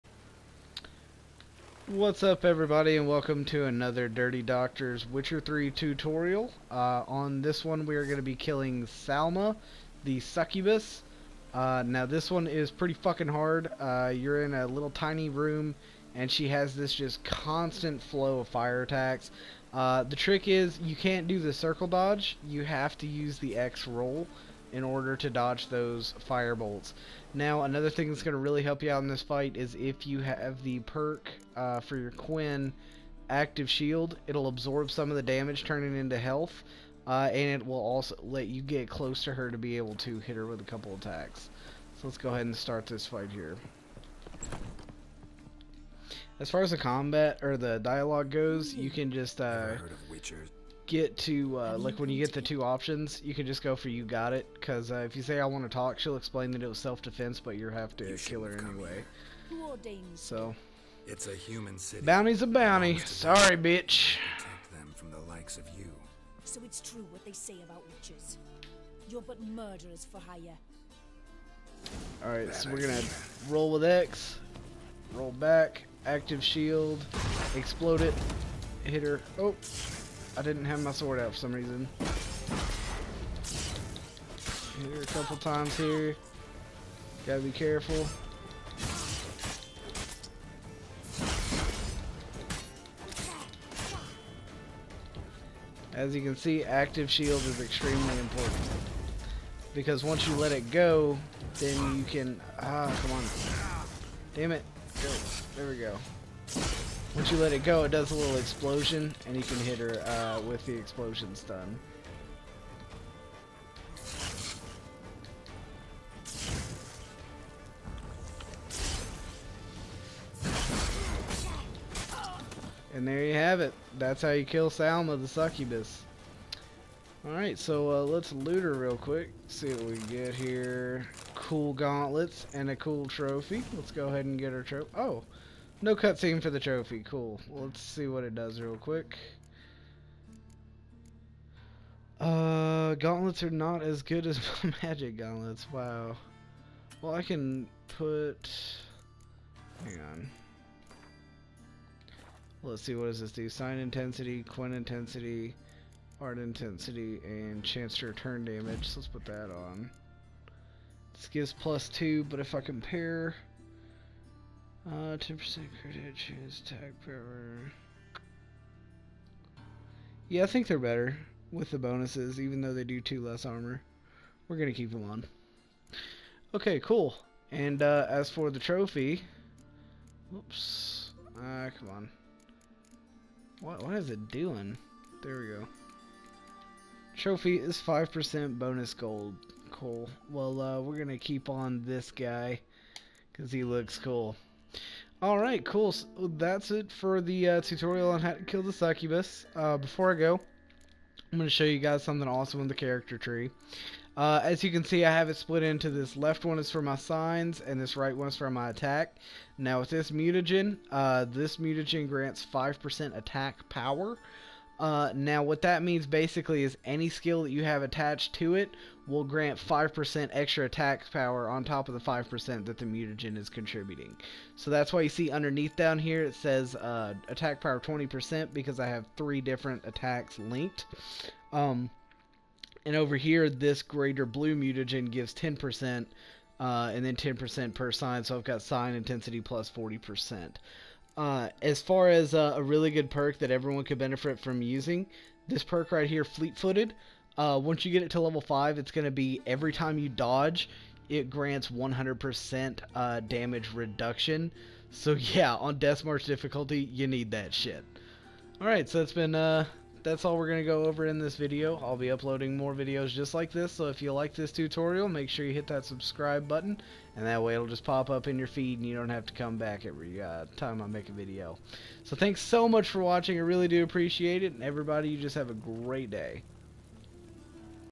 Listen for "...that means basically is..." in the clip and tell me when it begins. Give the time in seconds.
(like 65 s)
215 s.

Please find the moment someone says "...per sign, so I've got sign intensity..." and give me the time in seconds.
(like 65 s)
237 s.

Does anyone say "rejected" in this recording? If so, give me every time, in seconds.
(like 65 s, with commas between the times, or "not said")
not said.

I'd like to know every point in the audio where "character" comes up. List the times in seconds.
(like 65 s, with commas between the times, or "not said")
202 s.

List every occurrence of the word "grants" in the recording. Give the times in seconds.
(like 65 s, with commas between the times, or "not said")
212 s, 219 s, 251 s.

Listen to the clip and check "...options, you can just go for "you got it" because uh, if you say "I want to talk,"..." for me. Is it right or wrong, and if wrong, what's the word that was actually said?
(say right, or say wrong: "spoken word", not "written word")
right.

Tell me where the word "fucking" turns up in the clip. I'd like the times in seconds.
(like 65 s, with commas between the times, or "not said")
12 s.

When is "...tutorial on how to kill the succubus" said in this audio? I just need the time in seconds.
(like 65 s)
197 s.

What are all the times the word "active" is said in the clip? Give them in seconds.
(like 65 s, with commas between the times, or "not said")
33 s, 76 s, 96 s.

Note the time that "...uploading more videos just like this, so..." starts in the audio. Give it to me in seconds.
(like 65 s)
262 s.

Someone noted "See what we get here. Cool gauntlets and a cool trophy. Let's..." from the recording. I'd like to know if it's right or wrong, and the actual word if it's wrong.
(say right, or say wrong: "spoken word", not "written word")
right.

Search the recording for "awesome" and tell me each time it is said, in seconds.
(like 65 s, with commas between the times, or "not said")
202 s.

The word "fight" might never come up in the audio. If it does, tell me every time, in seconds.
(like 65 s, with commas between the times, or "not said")
29 s, 43 s.